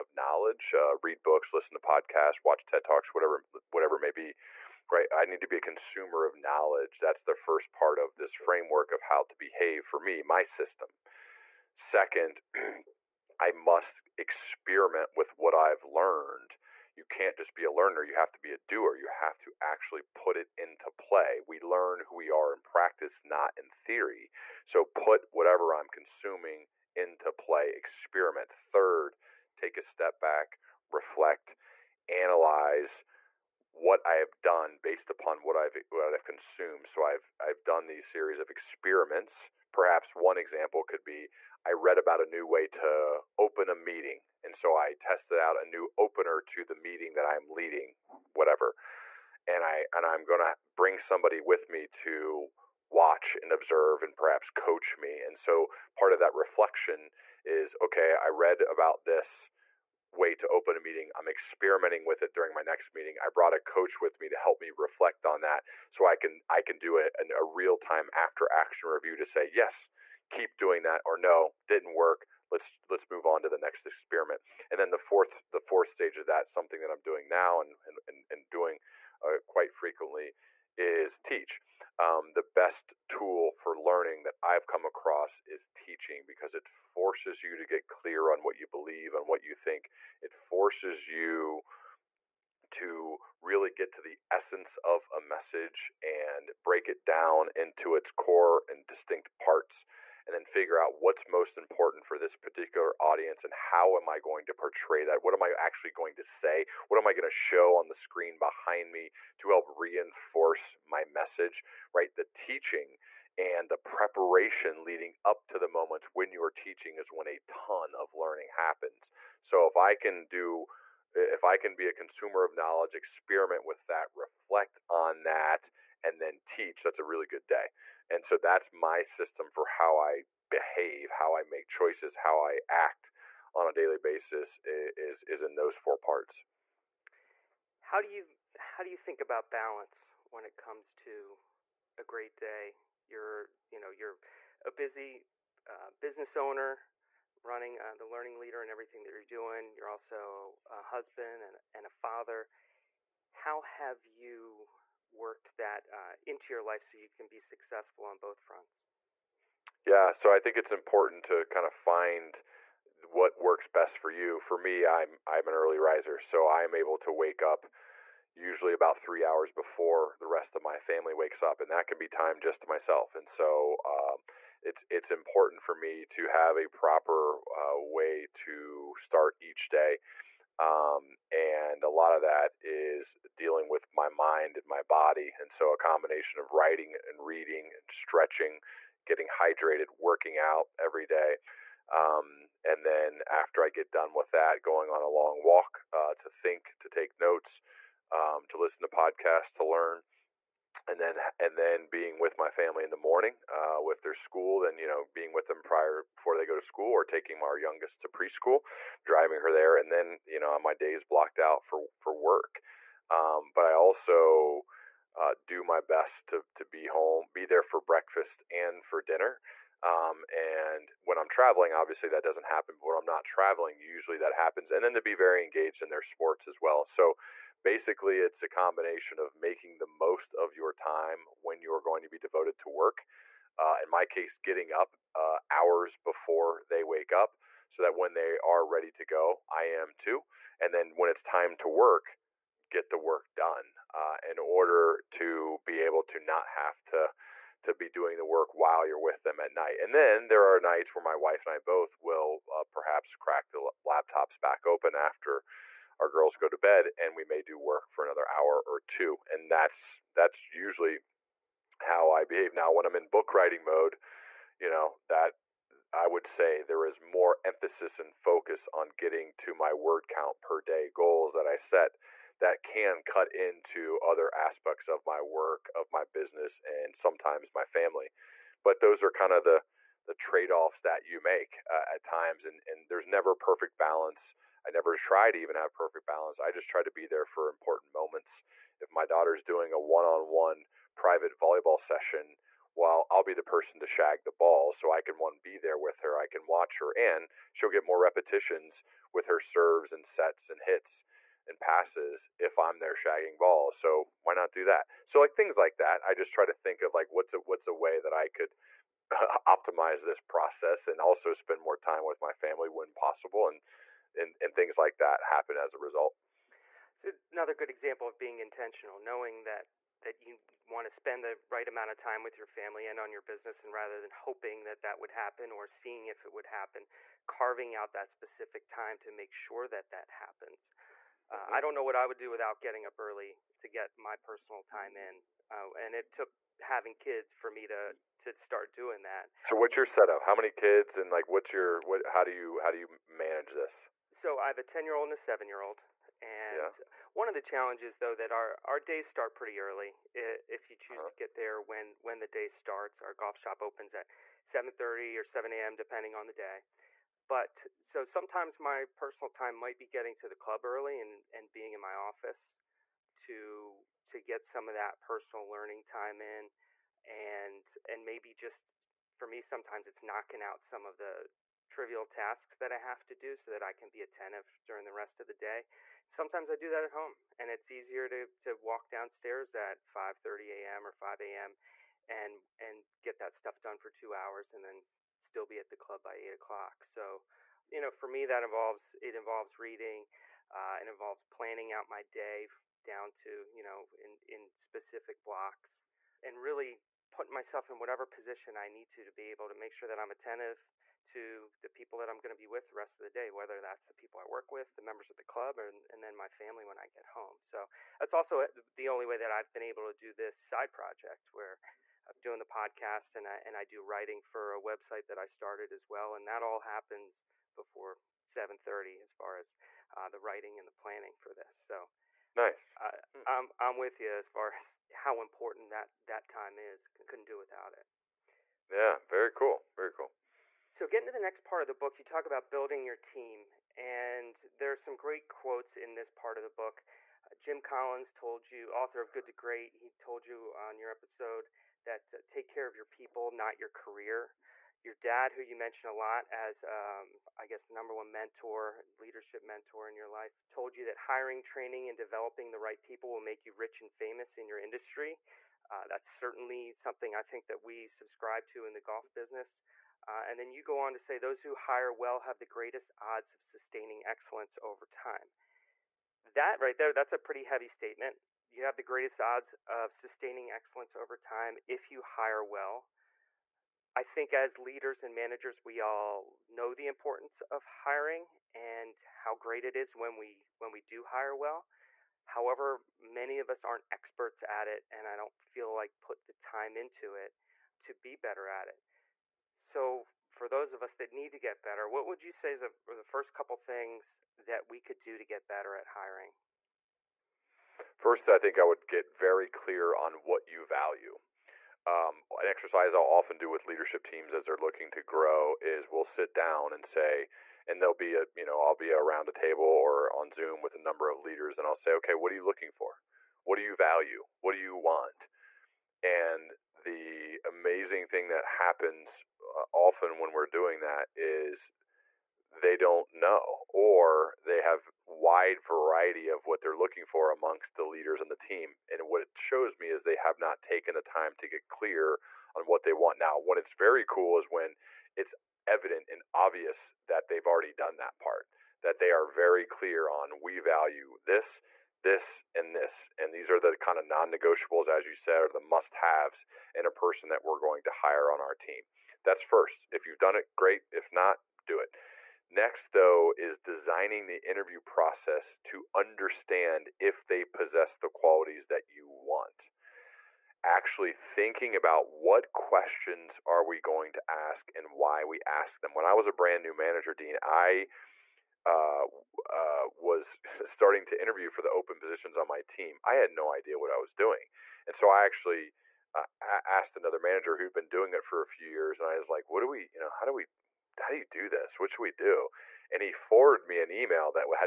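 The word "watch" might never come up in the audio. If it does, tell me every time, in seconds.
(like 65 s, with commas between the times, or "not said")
2 s, 52 s, 296 s.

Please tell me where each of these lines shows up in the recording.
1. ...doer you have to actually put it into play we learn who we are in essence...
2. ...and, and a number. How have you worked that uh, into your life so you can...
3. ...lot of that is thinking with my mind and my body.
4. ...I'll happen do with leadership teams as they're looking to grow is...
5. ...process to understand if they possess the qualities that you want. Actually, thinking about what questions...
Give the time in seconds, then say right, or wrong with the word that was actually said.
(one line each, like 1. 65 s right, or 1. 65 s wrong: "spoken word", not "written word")
1. 18 s wrong: "practice", not "essence"
2. 151 s wrong: "father", not "number"
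3. 181 s wrong: "dealing", not "thinking"
4. 502 s wrong: "often", not "happen"
5. 554 s right.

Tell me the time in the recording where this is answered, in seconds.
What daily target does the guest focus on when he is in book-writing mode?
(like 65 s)
269 s.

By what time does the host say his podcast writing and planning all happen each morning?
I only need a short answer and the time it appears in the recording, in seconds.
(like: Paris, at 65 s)
7:30, at 418 s.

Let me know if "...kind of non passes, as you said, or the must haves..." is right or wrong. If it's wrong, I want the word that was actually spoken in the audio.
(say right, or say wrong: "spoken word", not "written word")
wrong: "negotiables", not "passes".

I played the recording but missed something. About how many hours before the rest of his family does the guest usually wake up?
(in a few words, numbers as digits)
3.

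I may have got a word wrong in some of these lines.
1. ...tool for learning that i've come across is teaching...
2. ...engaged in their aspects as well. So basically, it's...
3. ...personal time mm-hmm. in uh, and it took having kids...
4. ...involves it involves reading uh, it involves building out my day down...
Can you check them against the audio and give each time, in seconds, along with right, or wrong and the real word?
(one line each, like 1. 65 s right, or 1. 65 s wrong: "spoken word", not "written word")
1. 83 s right
2. 225 s wrong: "sports", not "aspects"
3. 334 s right
4. 388 s wrong: "planning", not "building".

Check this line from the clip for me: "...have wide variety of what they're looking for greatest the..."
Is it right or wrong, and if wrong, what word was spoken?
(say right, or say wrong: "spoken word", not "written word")
wrong: "amongst", not "greatest".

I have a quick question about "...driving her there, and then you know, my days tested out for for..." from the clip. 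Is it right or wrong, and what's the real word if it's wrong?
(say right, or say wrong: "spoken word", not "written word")
wrong: "blocked", not "tested".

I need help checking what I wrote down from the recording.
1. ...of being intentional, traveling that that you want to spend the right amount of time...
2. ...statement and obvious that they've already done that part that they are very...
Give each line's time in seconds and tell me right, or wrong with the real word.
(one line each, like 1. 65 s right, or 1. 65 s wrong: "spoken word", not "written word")
1. 318 s wrong: "knowing", not "traveling"
2. 535 s wrong: "evident", not "statement".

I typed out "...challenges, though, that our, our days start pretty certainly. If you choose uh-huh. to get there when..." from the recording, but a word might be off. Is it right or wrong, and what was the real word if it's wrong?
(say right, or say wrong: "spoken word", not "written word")
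wrong: "early", not "certainly".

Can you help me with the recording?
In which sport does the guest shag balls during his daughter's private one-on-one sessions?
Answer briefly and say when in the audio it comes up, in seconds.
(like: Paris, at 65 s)
Volleyball, at 291 s.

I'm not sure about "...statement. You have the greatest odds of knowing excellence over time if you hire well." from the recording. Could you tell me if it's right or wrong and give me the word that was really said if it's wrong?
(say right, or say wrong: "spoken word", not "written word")
wrong: "sustaining", not "knowing".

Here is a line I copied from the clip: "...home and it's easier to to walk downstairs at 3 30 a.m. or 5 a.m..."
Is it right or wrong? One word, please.
wrong.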